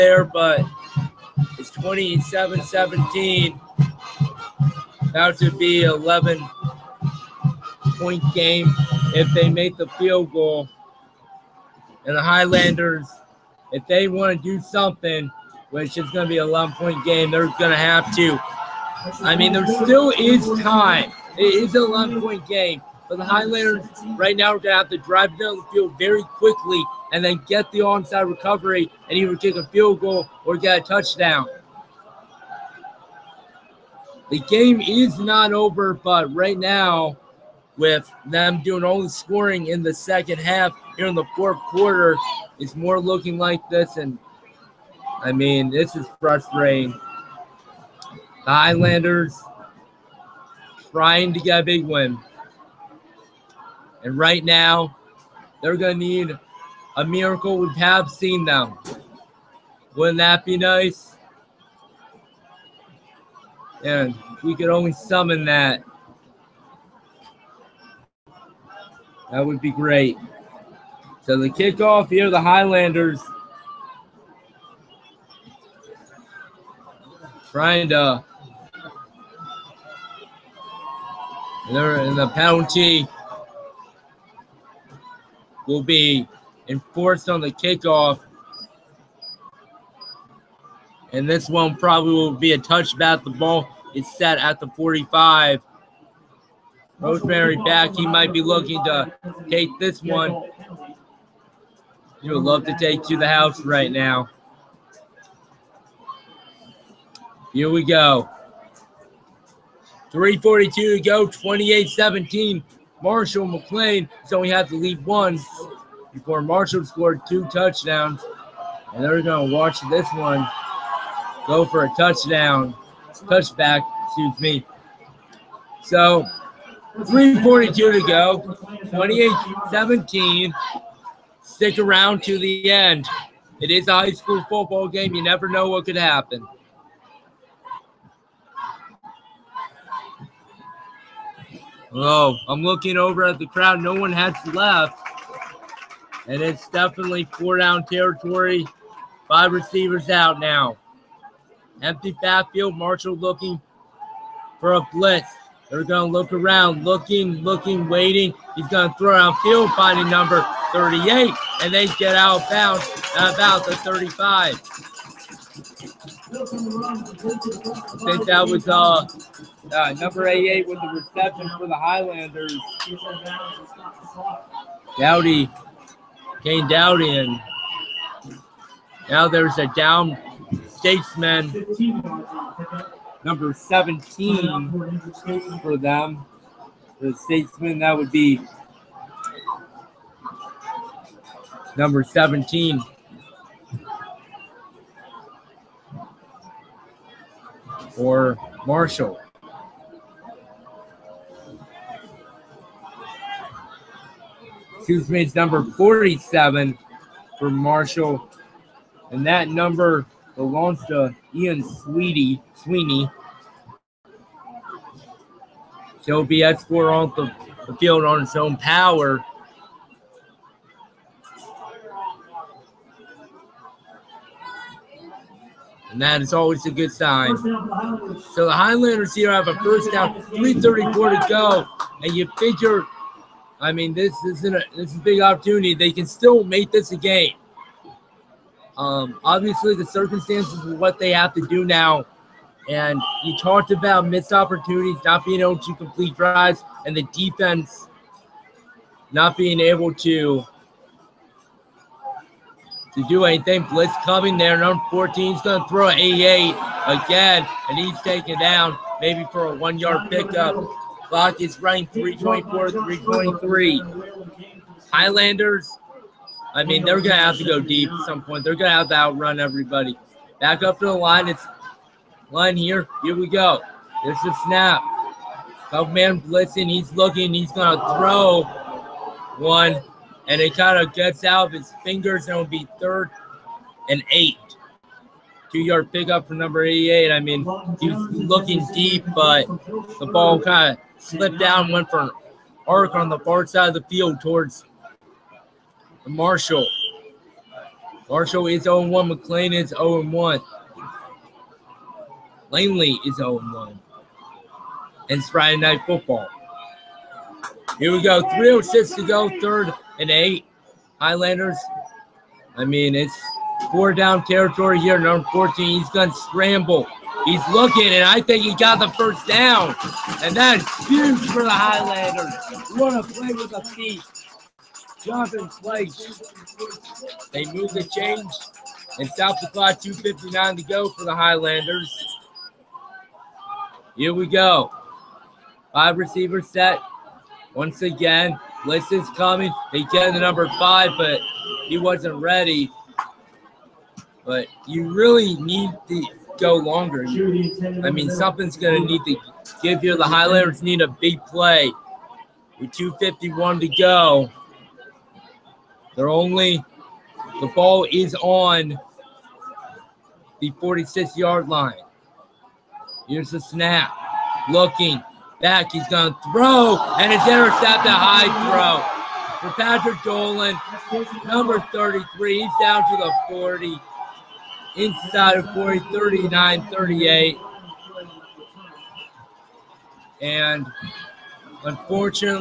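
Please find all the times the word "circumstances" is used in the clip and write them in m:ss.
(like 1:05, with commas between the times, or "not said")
3:59.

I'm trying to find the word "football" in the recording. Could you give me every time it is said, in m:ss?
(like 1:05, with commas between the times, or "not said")
2:14, 5:05.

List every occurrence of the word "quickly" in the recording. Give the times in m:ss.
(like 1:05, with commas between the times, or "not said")
0:26.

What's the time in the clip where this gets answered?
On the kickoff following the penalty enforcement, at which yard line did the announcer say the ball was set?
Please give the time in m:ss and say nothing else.
1:34.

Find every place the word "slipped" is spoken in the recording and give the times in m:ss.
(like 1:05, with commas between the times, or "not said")
4:51.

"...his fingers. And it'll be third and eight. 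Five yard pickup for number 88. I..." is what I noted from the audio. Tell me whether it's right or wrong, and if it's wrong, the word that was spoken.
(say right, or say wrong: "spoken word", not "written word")
wrong: "Two", not "Five".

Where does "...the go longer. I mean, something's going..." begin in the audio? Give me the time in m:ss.
5:45.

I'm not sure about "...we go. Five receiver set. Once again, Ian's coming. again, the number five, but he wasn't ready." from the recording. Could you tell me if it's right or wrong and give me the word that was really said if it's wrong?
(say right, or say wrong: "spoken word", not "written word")
wrong: "Liston", not "Ian".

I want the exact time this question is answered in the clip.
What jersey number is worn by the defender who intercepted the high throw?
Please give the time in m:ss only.
6:11.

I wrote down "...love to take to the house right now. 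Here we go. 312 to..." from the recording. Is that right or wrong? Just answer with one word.
wrong.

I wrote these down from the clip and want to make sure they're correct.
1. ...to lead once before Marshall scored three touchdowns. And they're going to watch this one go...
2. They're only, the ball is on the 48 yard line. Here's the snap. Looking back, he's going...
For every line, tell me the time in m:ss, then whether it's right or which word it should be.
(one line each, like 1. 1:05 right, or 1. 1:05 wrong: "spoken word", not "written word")
1. 1:54 wrong: "two", not "three"
2. 5:55 wrong: "46", not "48".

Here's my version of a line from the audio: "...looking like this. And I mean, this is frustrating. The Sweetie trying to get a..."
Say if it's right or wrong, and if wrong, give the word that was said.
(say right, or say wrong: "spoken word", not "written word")
wrong: "Highlanders", not "Sweetie".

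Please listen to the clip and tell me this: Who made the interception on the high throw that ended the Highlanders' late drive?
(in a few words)
Patrick Dolan.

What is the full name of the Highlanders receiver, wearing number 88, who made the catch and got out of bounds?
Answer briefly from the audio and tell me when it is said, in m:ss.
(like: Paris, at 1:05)
Kane Dowdy, at 2:56.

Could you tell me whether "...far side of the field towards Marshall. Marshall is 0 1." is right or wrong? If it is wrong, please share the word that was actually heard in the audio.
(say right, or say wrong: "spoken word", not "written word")
right.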